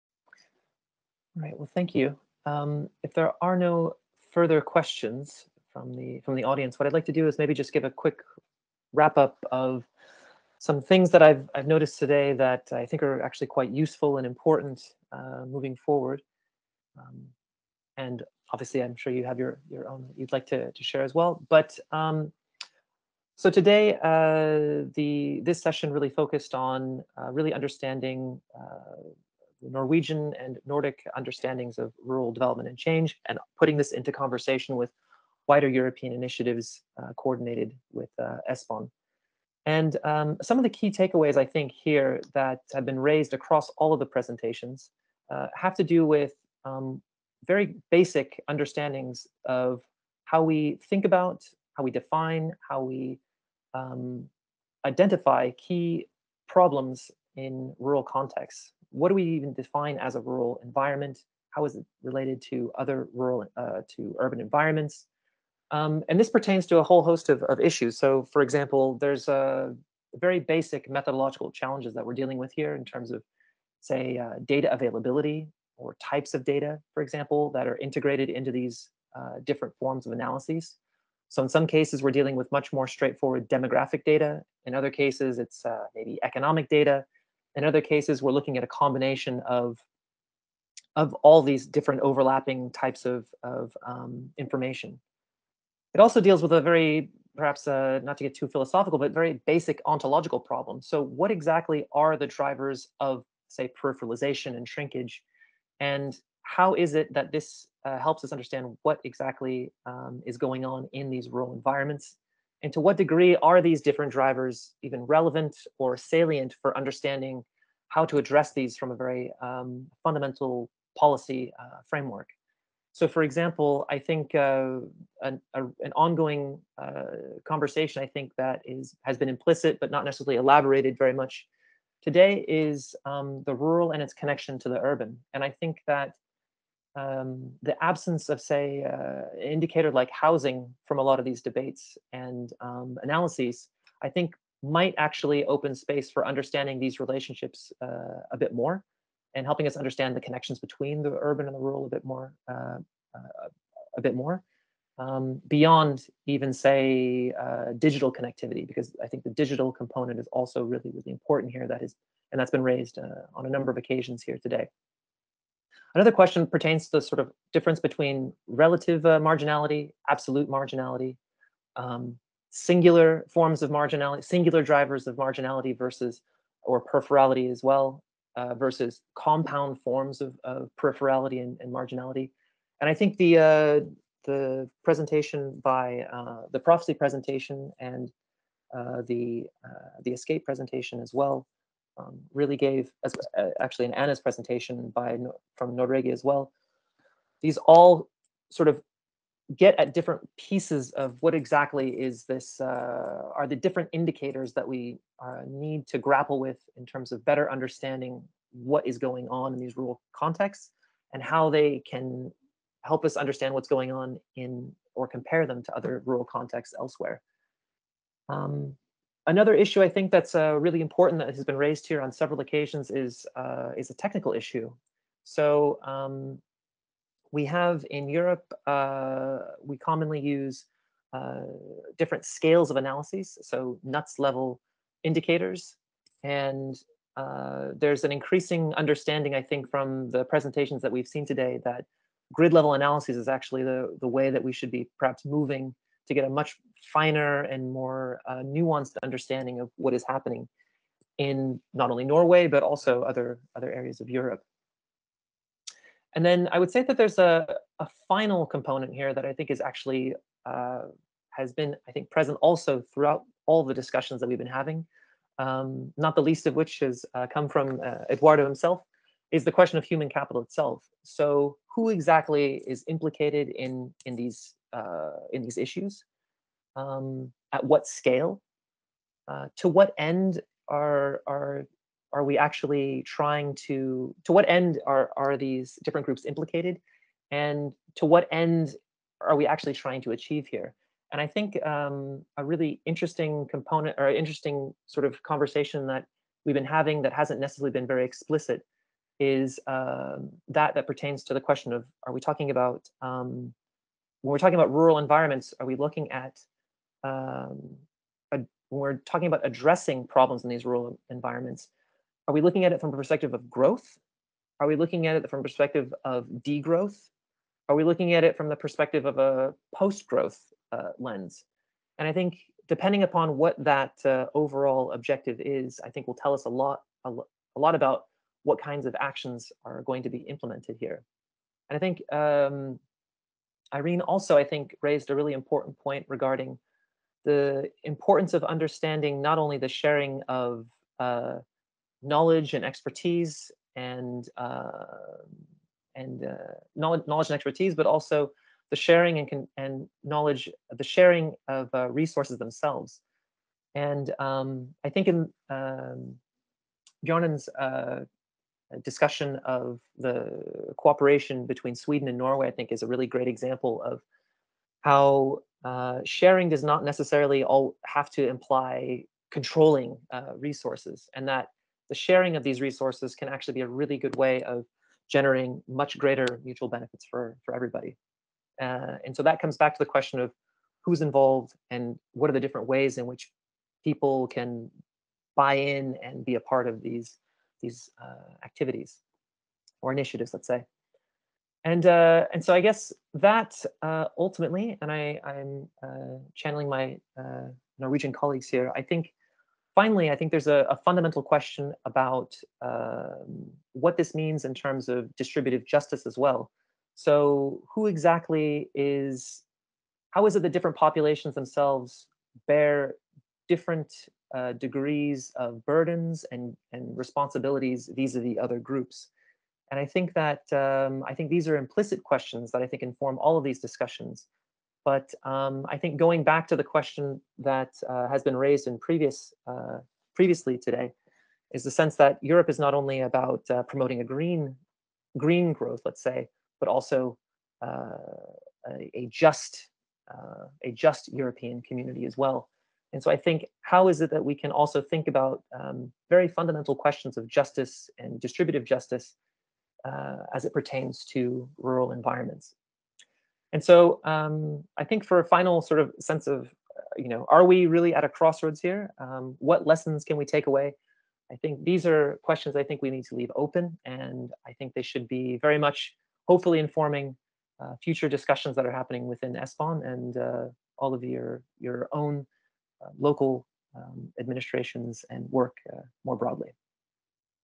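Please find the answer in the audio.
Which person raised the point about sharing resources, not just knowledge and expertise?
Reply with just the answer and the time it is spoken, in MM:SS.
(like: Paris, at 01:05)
Irene, at 05:33.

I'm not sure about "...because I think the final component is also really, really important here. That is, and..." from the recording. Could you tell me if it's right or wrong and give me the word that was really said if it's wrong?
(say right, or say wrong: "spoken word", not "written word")
wrong: "digital", not "final".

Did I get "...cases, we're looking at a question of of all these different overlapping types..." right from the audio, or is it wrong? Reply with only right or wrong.
wrong.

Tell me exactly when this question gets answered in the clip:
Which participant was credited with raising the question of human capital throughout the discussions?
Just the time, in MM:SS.
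04:28.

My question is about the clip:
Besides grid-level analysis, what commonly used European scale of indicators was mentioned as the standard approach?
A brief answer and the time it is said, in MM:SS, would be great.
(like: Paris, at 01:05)
NUTS level, at 03:53.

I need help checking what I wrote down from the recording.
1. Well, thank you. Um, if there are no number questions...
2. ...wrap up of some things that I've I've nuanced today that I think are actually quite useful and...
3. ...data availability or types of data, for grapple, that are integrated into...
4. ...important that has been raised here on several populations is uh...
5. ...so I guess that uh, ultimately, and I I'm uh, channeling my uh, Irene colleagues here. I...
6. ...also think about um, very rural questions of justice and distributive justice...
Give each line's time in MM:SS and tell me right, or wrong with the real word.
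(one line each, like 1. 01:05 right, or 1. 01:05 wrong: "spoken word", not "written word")
1. 00:01 wrong: "further", not "number"
2. 00:08 wrong: "noticed", not "nuanced"
3. 01:14 wrong: "example", not "grapple"
4. 03:40 wrong: "occasions", not "populations"
5. 06:32 wrong: "Norwegian", not "Irene"
6. 07:24 wrong: "fundamental", not "rural".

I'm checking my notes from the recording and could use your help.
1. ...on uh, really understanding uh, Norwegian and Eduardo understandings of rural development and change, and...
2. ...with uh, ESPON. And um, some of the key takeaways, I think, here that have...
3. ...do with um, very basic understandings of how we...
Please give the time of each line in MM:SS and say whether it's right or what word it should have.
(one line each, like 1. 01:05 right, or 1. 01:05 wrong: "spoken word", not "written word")
1. 00:26 wrong: "Nordic", not "Eduardo"
2. 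00:37 right
3. 00:45 right.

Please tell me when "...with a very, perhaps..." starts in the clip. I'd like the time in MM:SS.
01:36.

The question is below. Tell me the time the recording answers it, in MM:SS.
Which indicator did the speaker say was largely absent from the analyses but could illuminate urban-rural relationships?
02:20.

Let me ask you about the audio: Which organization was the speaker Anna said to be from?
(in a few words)
Nordregio.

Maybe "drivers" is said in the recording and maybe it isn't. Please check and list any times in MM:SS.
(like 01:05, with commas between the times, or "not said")
01:42, 01:54, 02:54.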